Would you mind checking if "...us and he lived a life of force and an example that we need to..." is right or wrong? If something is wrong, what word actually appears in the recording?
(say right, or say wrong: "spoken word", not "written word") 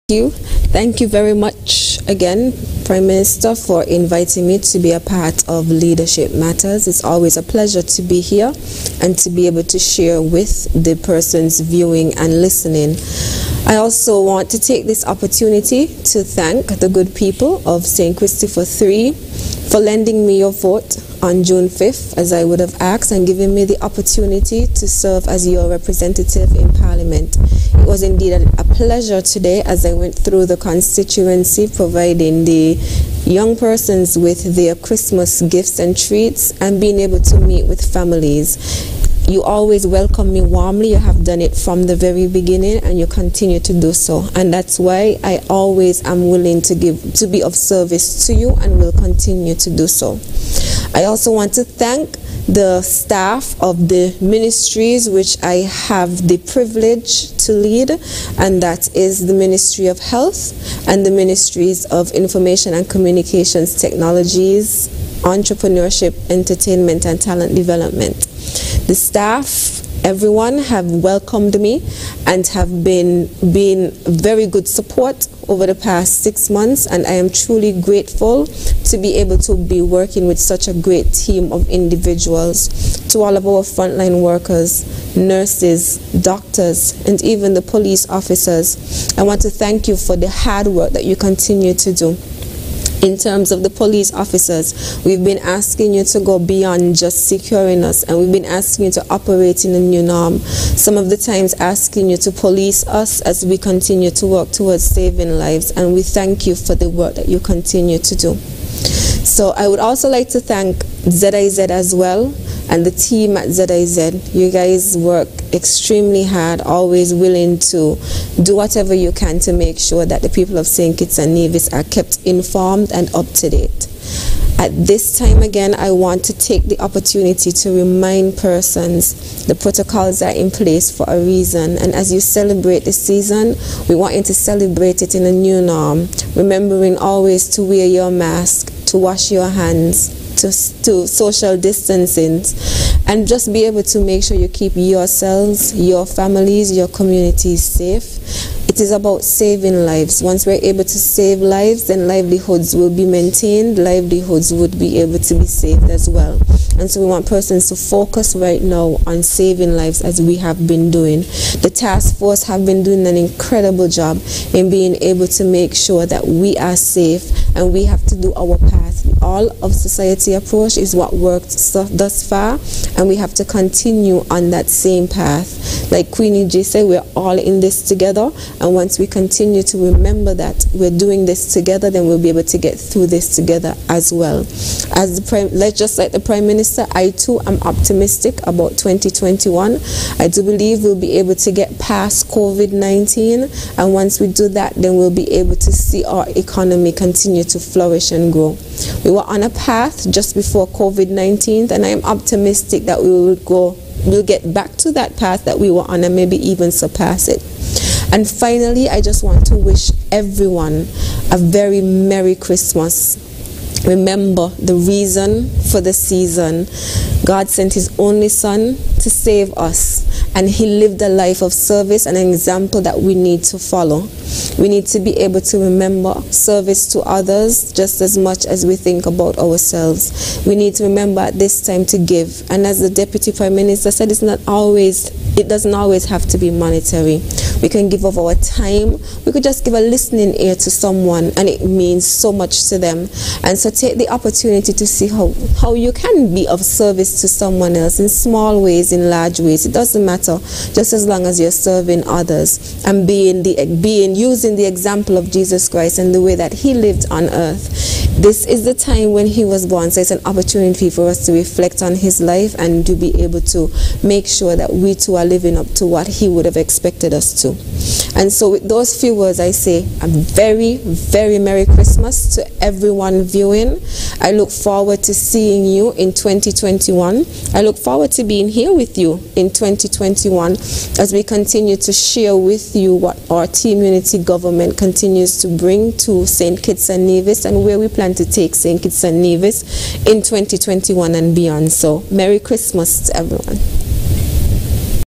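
wrong: "service", not "force".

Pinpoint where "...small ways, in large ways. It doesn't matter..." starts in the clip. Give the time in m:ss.
4:08.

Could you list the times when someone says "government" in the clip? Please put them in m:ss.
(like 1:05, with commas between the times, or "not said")
4:44.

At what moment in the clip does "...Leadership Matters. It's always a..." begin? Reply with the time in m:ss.
0:05.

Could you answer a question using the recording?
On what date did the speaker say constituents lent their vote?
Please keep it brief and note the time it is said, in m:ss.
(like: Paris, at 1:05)
June 5th, at 0:21.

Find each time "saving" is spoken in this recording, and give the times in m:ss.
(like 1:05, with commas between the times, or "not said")
1:44, 2:29, 2:39.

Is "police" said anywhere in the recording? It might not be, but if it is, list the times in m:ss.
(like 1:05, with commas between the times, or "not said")
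1:27, 1:33, 1:42.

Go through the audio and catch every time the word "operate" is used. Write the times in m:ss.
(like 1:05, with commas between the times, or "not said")
1:39.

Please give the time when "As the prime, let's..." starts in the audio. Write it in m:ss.
3:04.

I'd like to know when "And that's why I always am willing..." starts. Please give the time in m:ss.
0:44.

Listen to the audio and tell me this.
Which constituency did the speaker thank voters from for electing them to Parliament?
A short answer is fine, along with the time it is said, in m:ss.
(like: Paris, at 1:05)
St. Christopher 3, at 0:17.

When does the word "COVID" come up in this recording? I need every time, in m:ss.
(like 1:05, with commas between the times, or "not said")
3:12, 3:20.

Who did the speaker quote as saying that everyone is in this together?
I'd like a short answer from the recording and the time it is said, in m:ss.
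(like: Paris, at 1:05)
Queenie J, at 2:56.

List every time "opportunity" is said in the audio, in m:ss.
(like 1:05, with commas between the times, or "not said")
0:15, 0:23, 2:06, 4:04, 4:20.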